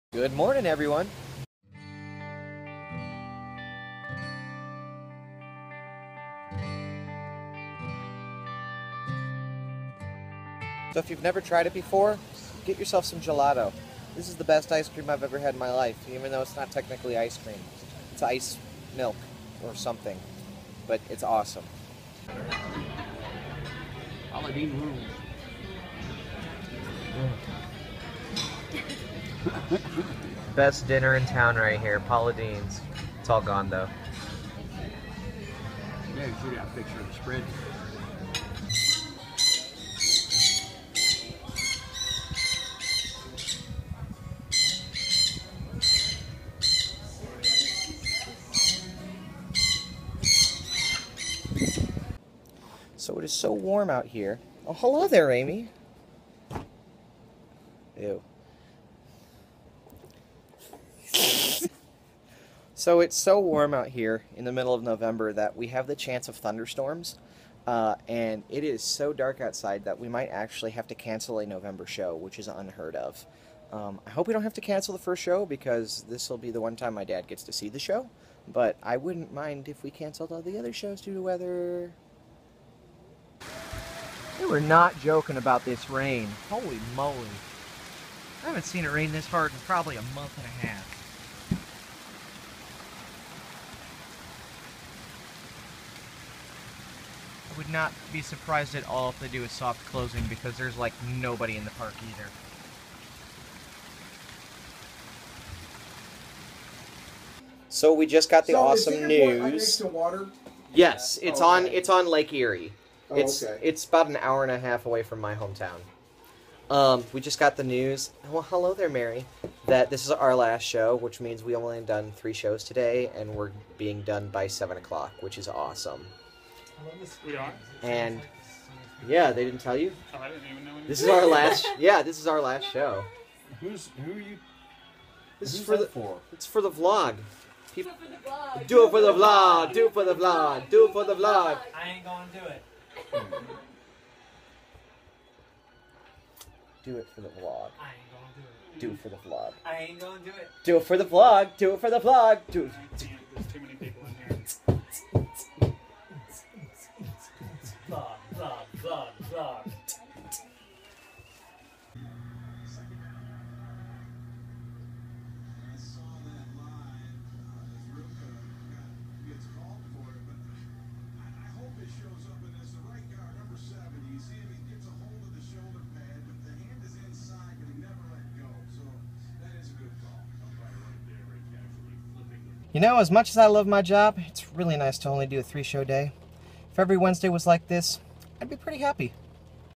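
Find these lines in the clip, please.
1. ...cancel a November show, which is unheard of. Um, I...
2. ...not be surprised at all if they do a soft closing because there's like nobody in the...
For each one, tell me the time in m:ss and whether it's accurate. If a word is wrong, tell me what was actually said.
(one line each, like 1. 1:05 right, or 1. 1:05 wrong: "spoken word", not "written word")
1. 1:10 right
2. 1:37 right.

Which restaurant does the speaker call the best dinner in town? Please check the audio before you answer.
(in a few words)
Paula Deen's.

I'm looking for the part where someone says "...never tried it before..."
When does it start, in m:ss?
0:11.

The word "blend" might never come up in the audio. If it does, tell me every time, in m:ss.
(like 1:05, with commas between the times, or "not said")
not said.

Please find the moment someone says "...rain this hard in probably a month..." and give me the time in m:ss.
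1:28.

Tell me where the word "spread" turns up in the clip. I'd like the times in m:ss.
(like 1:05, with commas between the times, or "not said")
0:37.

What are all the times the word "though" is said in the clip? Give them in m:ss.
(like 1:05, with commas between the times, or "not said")
0:16, 0:33.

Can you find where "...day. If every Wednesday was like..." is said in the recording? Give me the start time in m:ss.
3:05.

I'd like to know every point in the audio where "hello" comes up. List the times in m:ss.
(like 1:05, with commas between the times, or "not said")
0:54, 1:58.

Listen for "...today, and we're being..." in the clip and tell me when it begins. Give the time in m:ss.
2:02.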